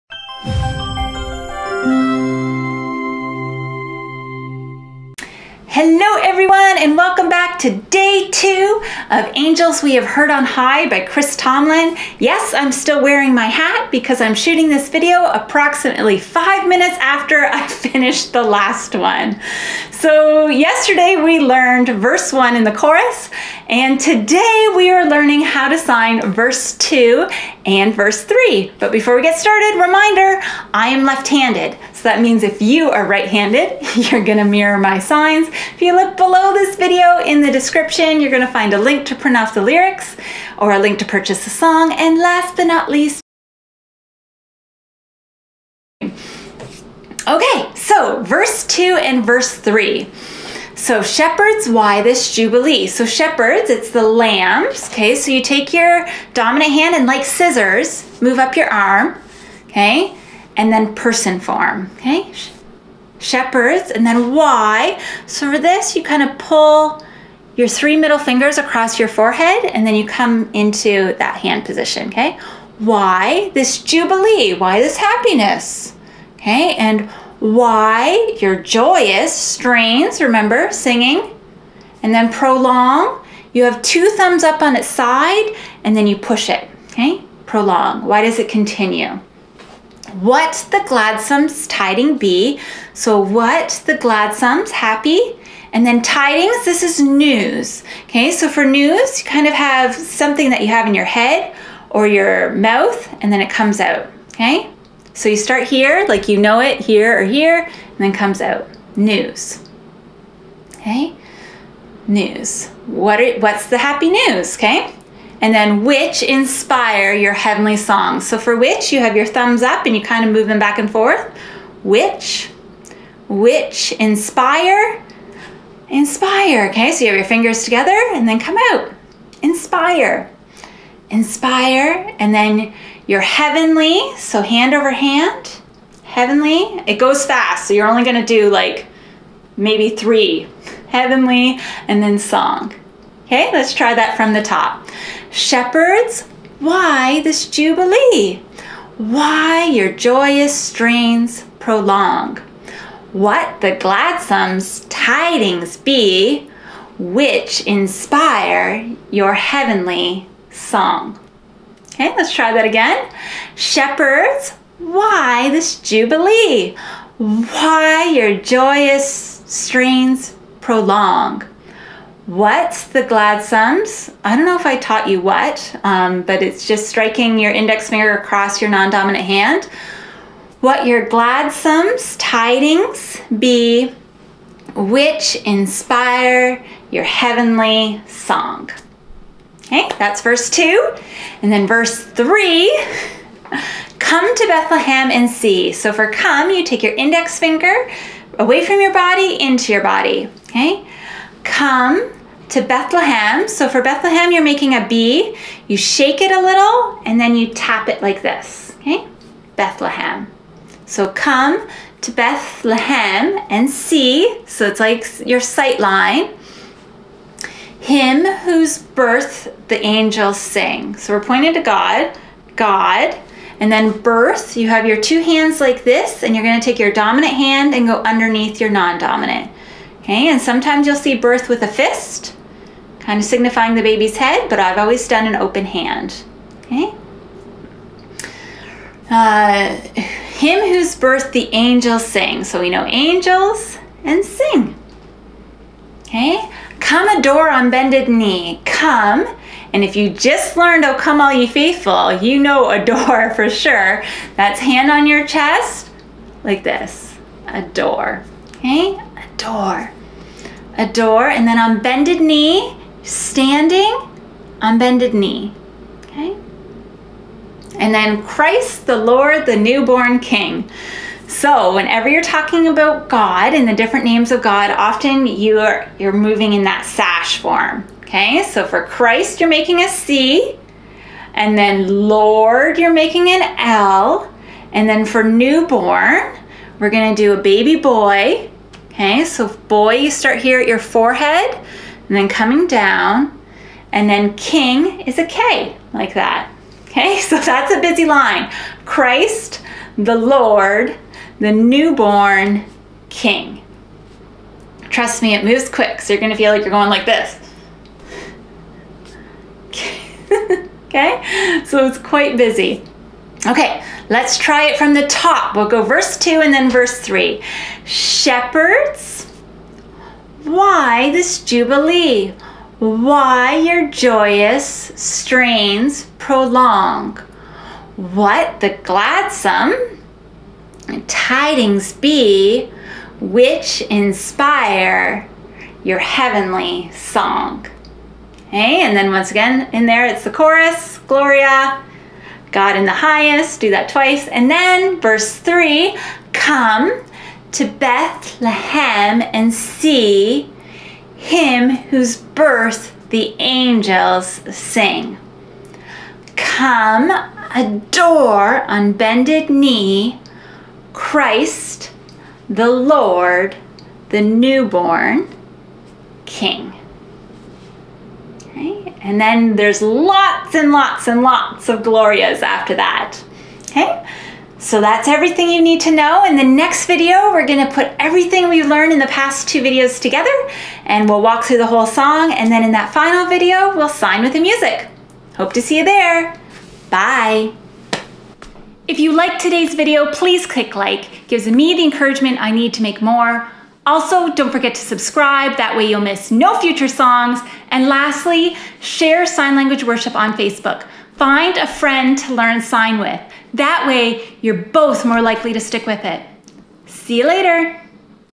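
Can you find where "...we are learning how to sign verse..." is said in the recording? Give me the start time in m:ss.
0:24.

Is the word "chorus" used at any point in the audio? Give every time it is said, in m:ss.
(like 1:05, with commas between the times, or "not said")
0:22, 5:40.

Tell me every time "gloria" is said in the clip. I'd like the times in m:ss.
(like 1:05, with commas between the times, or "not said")
5:41, 6:11.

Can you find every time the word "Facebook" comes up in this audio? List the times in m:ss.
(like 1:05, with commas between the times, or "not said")
6:40.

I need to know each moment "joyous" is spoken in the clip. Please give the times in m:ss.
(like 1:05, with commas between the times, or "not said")
1:18, 2:29, 2:48, 5:23.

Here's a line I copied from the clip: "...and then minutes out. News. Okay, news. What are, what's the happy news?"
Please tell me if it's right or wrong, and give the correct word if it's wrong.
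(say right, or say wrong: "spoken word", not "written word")
wrong: "comes", not "minutes".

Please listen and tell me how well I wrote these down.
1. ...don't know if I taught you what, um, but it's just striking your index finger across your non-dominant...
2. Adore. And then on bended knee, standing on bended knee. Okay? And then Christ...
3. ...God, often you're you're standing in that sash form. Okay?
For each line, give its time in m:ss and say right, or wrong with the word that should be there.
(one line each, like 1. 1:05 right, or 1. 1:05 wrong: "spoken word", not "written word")
1. 2:54 right
2. 4:20 right
3. 4:34 wrong: "moving", not "standing".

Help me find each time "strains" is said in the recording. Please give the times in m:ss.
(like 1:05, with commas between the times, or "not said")
1:19, 2:30, 2:49, 5:24.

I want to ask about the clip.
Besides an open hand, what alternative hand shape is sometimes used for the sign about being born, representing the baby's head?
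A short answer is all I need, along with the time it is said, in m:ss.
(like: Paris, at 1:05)
A fist, at 3:51.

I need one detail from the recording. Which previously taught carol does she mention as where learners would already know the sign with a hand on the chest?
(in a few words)
Oh Come All Ye Faithful.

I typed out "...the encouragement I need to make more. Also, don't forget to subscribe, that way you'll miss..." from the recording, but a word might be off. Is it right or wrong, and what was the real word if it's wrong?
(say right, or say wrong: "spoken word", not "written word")
right.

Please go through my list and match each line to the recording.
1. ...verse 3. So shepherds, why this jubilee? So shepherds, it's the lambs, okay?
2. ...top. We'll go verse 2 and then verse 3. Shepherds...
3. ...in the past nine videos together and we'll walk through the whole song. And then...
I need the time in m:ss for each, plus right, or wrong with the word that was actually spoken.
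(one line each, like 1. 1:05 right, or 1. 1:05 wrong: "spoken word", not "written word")
1. 0:49 right
2. 5:15 right
3. 6:18 wrong: "two", not "nine".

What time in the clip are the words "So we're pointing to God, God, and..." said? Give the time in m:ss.
3:40.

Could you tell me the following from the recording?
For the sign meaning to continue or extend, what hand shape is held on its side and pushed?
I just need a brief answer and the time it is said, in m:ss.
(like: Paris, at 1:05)
Two thumbs up, at 1:23.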